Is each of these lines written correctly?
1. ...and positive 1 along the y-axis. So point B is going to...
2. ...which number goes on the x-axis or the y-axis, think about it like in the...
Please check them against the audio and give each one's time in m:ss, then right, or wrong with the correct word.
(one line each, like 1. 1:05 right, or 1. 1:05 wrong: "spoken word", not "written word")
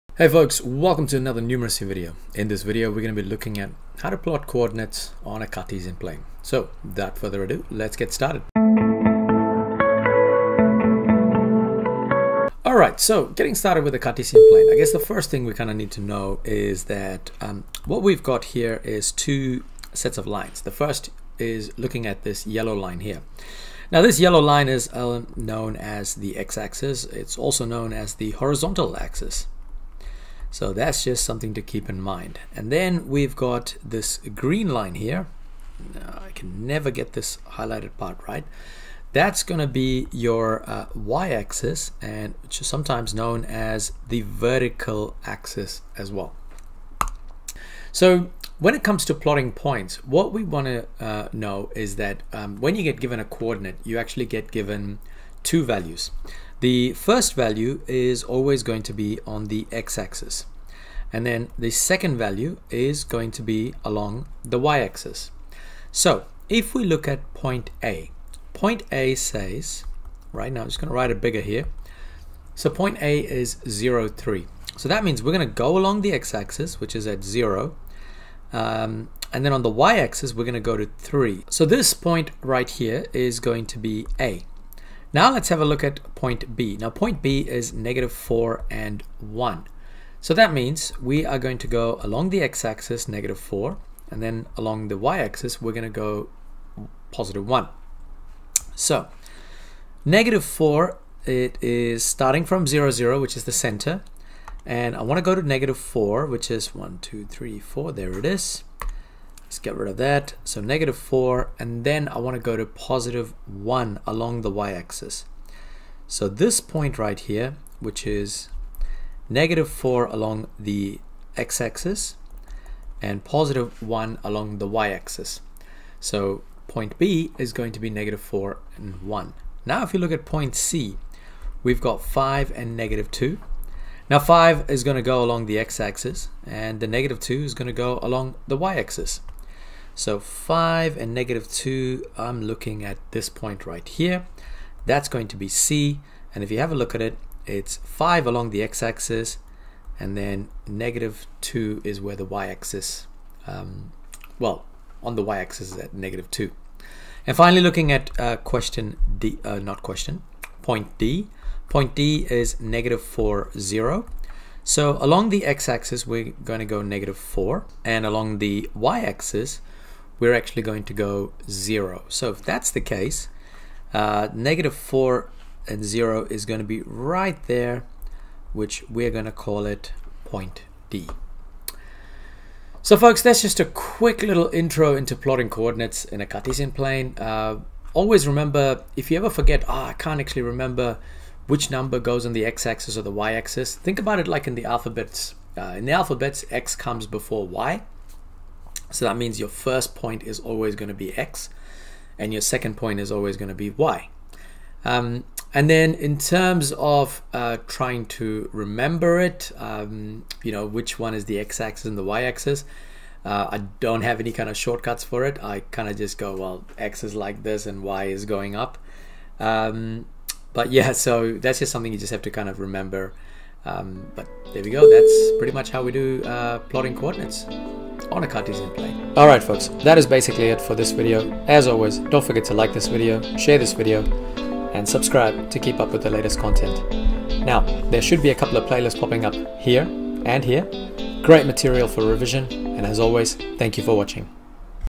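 1. 2:03 right
2. 3:11 right.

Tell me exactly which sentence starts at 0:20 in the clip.
The first is looking at this yellow line here.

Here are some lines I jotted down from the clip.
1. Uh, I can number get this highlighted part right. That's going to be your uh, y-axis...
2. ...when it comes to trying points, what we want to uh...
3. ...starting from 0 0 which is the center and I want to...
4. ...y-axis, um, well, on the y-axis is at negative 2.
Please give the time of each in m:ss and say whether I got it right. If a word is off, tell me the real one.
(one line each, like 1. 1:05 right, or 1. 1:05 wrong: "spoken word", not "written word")
1. 0:35 wrong: "never", not "number"
2. 0:48 wrong: "plotting", not "trying"
3. 1:42 right
4. 2:32 right.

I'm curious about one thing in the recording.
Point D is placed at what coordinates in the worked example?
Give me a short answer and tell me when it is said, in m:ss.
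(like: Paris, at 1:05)
-4, 0, at 2:42.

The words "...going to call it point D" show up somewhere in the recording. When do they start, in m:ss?
2:59.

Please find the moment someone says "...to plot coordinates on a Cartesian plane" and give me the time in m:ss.
0:04.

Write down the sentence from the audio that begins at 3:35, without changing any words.
I kind of just go, well, x is like this and y is going up.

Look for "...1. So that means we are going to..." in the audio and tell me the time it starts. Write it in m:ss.
1:29.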